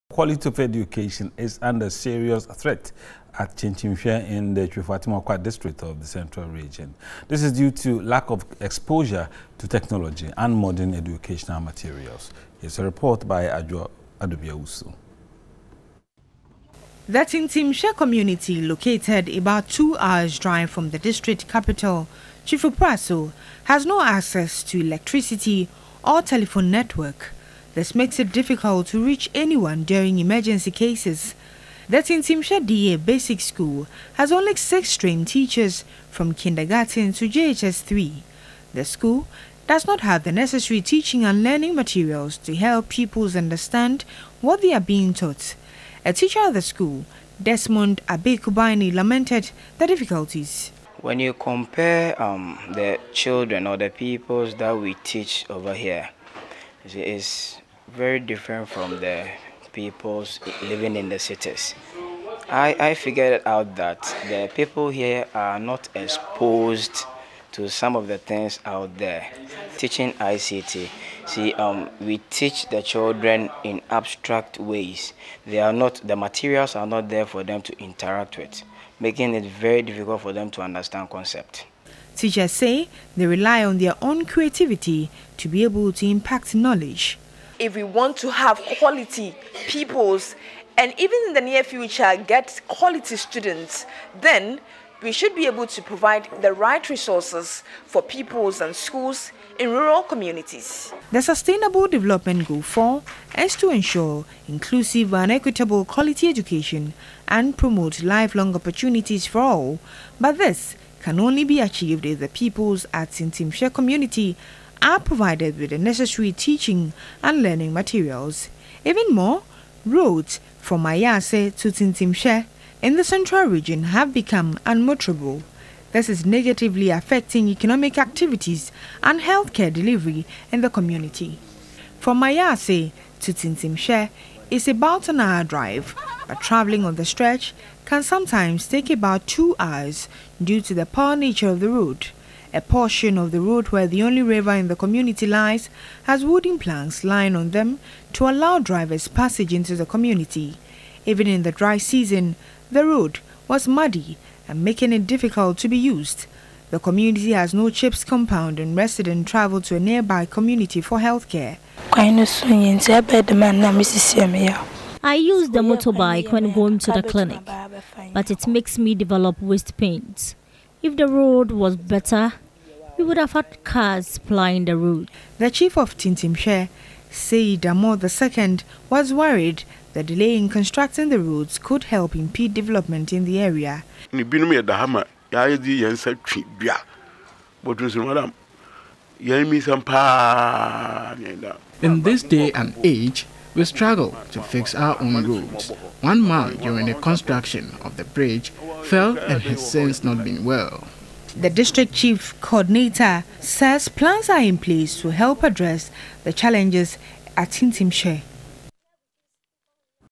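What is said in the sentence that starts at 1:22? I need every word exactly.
Teachers say they rely on their own creativity to be able to impact knowledge.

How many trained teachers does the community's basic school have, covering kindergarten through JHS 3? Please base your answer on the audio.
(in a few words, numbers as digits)
6.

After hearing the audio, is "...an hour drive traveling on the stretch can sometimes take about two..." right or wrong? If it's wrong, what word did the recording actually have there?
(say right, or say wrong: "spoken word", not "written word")
right.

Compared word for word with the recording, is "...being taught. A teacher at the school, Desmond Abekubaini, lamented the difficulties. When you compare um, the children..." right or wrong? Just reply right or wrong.
right.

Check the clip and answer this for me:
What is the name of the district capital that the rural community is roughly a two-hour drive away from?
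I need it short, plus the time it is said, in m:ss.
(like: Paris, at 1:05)
Twifo Praso, at 0:22.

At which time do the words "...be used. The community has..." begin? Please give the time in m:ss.
2:35.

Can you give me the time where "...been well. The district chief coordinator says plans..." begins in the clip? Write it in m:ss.
3:20.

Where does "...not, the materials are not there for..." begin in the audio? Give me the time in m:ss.
1:15.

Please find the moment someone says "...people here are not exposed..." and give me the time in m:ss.
1:04.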